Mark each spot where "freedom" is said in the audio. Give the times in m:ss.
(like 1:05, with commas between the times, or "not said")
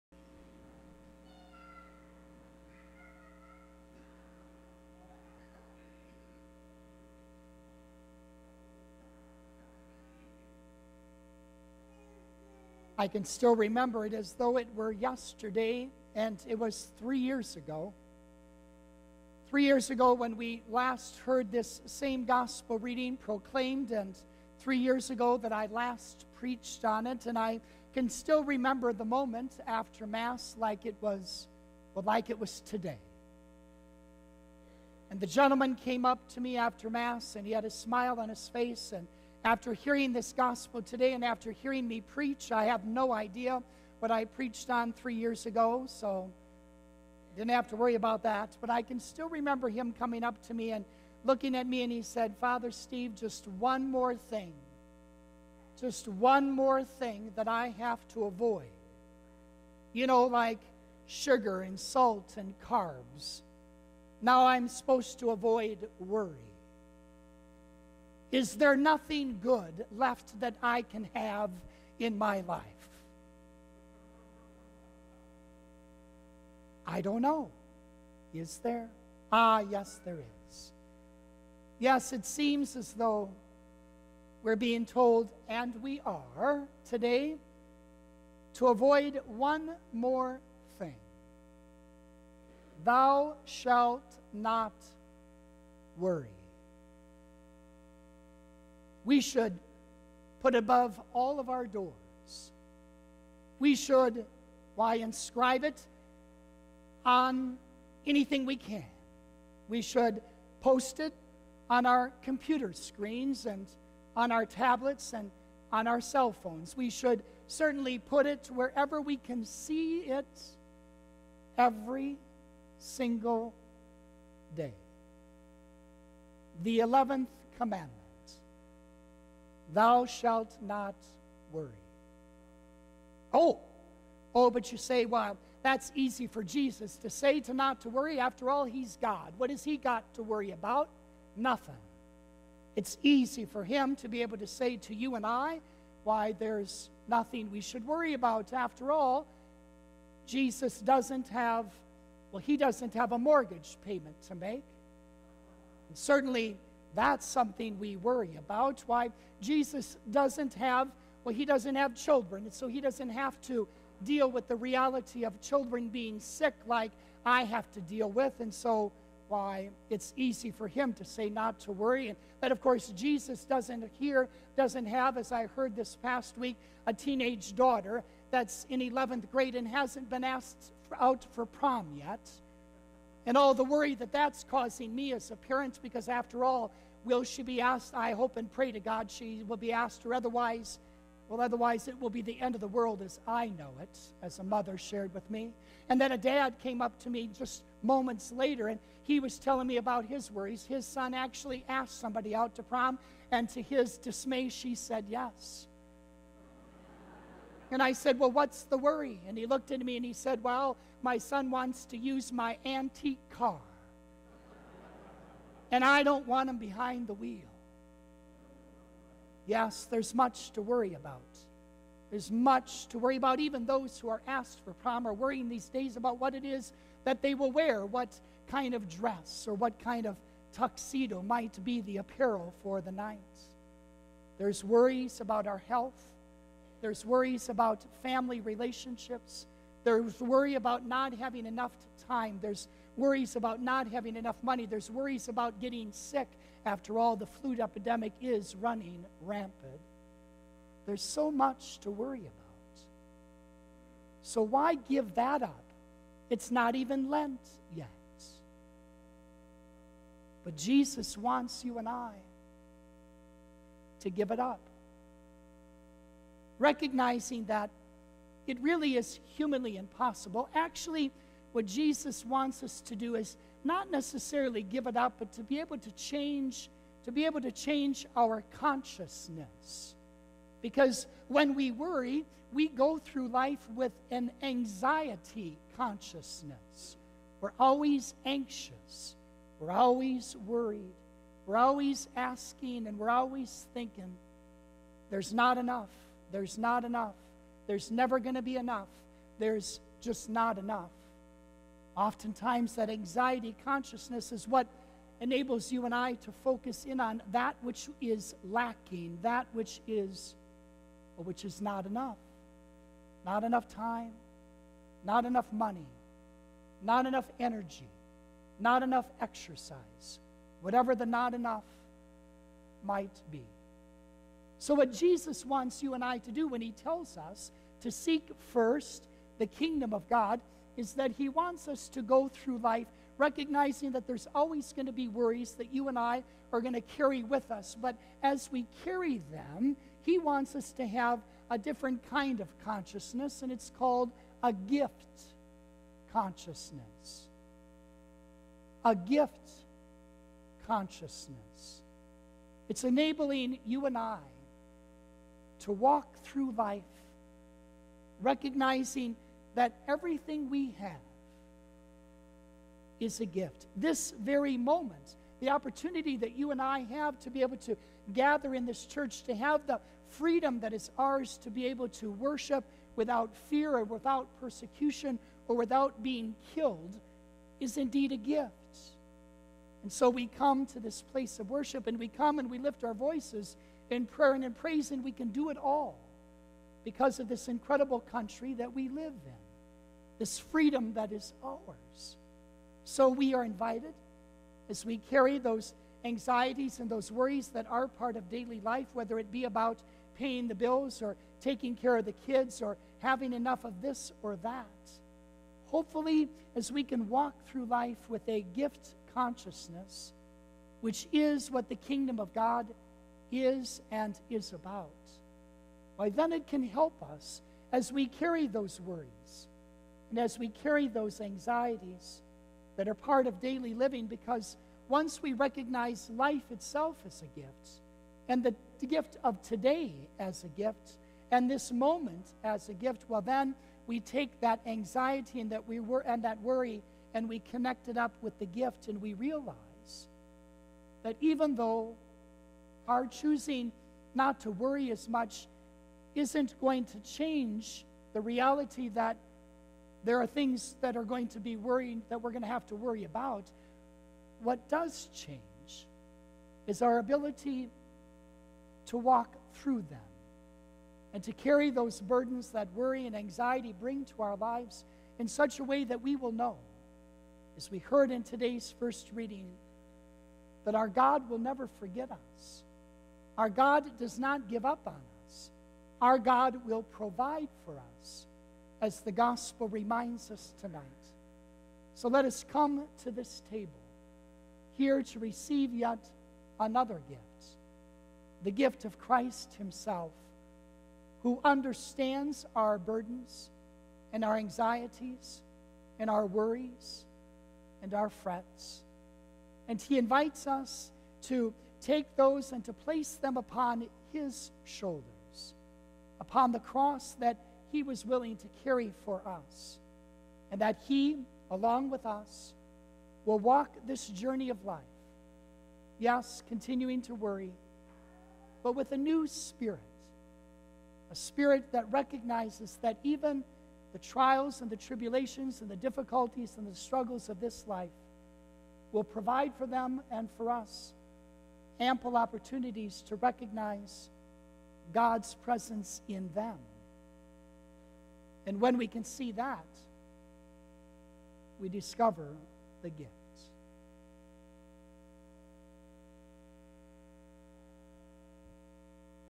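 6:10, 6:30.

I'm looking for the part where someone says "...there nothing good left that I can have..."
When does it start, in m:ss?
1:08.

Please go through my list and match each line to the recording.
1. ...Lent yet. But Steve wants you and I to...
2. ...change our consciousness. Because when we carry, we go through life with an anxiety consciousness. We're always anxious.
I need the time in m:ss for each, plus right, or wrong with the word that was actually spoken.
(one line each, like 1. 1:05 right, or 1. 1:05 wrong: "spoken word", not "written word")
1. 4:17 wrong: "Jesus", not "Steve"
2. 4:37 wrong: "worry", not "carry".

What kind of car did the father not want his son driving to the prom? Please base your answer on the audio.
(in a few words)
antique car.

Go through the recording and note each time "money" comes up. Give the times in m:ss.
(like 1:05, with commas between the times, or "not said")
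4:04, 5:15.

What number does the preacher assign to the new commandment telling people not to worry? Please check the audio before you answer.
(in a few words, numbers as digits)
11th.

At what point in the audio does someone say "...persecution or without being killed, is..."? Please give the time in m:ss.
6:14.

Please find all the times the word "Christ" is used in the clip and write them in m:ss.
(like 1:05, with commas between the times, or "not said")
8:08.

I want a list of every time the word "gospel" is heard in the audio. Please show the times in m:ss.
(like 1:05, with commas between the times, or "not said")
0:22, 0:40, 7:59.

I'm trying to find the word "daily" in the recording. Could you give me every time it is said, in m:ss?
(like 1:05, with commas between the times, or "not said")
6:38, 7:03.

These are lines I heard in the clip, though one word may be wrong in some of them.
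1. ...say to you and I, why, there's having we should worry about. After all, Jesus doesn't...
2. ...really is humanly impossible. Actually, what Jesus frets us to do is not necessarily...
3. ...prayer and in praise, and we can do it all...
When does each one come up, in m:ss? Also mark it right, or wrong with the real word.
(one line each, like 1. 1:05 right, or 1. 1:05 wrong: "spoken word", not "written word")
1. 2:24 wrong: "nothing", not "having"
2. 4:28 wrong: "wants", not "frets"
3. 6:24 right.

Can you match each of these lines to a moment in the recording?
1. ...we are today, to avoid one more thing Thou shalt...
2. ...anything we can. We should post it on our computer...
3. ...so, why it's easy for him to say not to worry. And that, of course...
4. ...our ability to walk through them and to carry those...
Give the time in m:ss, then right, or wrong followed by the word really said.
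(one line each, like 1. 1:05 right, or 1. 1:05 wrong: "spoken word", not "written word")
1. 1:25 right
2. 1:48 right
3. 2:48 right
4. 7:36 right.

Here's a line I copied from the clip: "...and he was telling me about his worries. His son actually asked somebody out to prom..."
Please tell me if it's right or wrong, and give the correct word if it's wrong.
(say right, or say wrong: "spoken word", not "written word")
right.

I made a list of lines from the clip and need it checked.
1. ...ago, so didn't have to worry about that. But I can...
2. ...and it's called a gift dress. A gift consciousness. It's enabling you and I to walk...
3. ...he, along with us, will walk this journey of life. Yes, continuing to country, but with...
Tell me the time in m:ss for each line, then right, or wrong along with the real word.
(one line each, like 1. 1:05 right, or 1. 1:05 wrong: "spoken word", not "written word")
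1. 0:45 right
2. 5:43 wrong: "consciousness", not "dress"
3. 8:30 wrong: "worry", not "country".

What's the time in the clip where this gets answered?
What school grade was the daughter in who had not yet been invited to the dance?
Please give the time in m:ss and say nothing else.
2:58.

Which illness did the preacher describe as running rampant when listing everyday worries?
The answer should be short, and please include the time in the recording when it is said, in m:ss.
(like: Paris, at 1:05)
flu, at 4:07.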